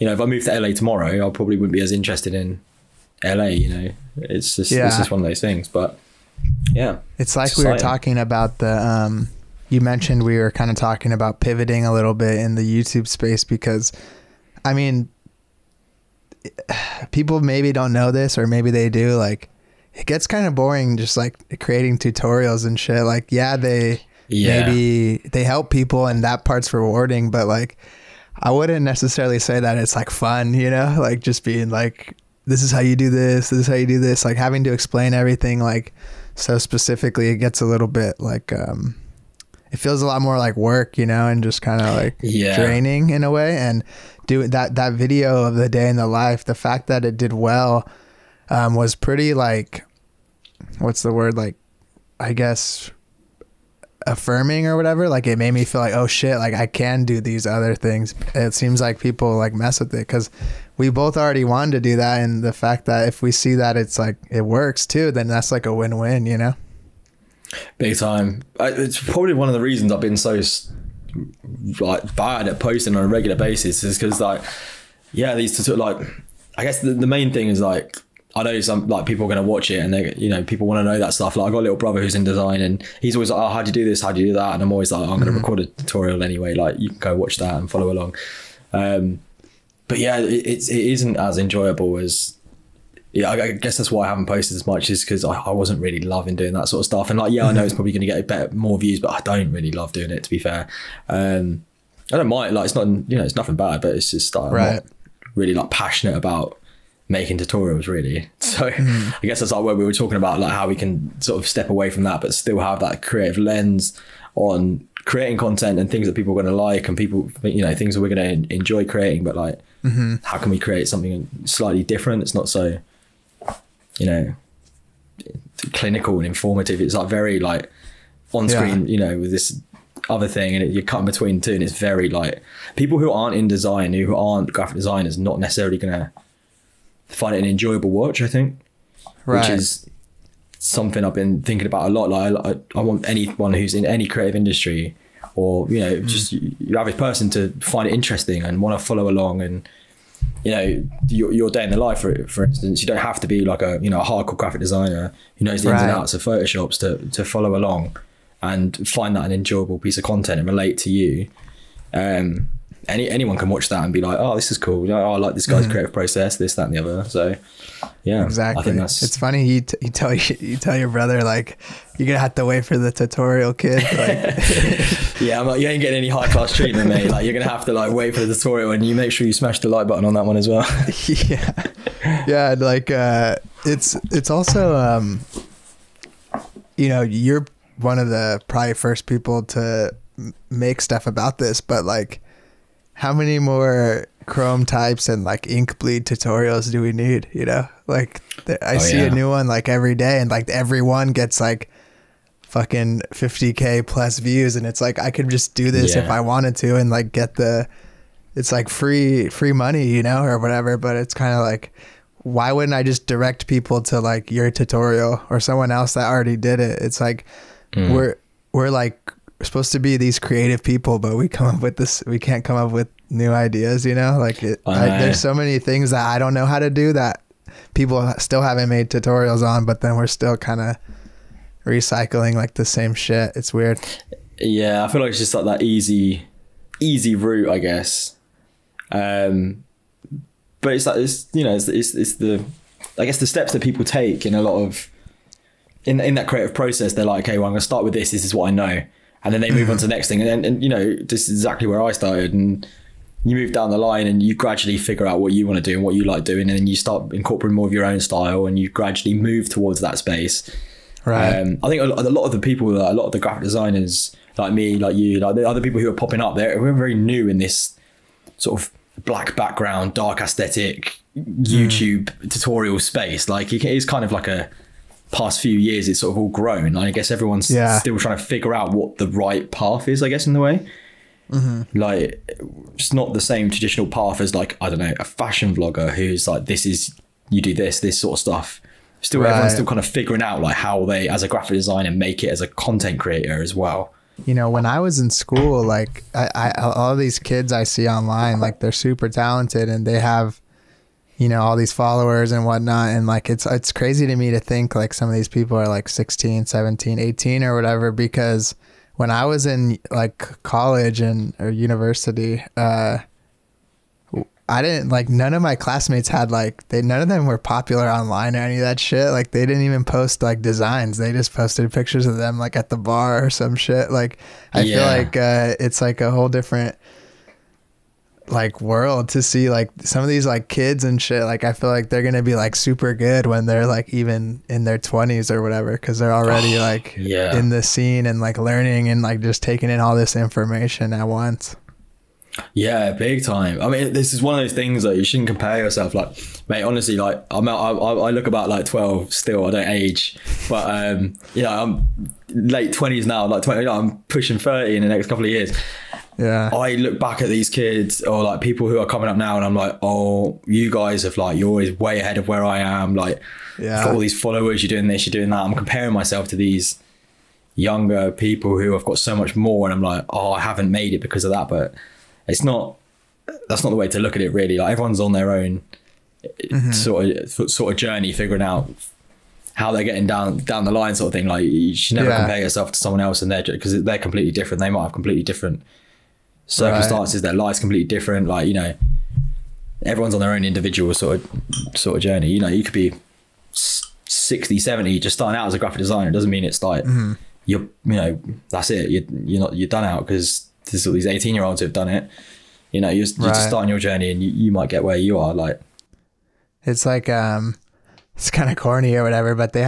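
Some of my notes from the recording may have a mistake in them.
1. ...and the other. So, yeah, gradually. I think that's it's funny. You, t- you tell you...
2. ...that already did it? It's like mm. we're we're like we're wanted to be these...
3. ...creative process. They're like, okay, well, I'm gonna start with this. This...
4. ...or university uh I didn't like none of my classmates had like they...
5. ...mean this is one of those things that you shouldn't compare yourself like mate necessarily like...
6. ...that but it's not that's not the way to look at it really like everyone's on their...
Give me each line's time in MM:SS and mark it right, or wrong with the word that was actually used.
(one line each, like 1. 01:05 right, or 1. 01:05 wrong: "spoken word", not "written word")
1. 02:46 wrong: "exactly", not "gradually"
2. 03:35 wrong: "supposed", not "wanted"
3. 04:06 right
4. 05:11 right
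5. 05:43 wrong: "honestly", not "necessarily"
6. 06:11 right.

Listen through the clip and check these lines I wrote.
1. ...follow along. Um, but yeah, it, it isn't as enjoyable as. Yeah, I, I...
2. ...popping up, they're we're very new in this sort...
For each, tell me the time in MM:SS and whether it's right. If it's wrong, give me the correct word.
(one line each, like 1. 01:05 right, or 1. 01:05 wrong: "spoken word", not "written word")
1. 01:27 right
2. 04:25 right.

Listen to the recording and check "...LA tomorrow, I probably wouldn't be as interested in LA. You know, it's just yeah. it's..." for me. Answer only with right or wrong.
right.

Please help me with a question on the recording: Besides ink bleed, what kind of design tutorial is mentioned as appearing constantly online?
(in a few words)
Chrome types.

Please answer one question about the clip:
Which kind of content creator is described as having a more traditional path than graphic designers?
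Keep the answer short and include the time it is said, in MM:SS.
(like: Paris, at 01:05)
fashion vlogger, at 04:45.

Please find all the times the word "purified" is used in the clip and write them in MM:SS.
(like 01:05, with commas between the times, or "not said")
not said.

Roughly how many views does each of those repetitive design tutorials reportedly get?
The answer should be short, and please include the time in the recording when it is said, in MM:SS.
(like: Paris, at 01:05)
50k plus, at 03:23.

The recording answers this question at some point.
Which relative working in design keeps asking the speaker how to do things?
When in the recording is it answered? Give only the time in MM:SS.
01:21.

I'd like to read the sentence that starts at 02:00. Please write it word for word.
how can we create something slightly different it's not so you know clinical and informative it's like very like on screen yeah.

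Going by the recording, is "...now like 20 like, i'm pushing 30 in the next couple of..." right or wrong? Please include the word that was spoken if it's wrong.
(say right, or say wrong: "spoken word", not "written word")
right.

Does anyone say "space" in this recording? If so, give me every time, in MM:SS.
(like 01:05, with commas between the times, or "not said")
00:13, 04:19, 04:32.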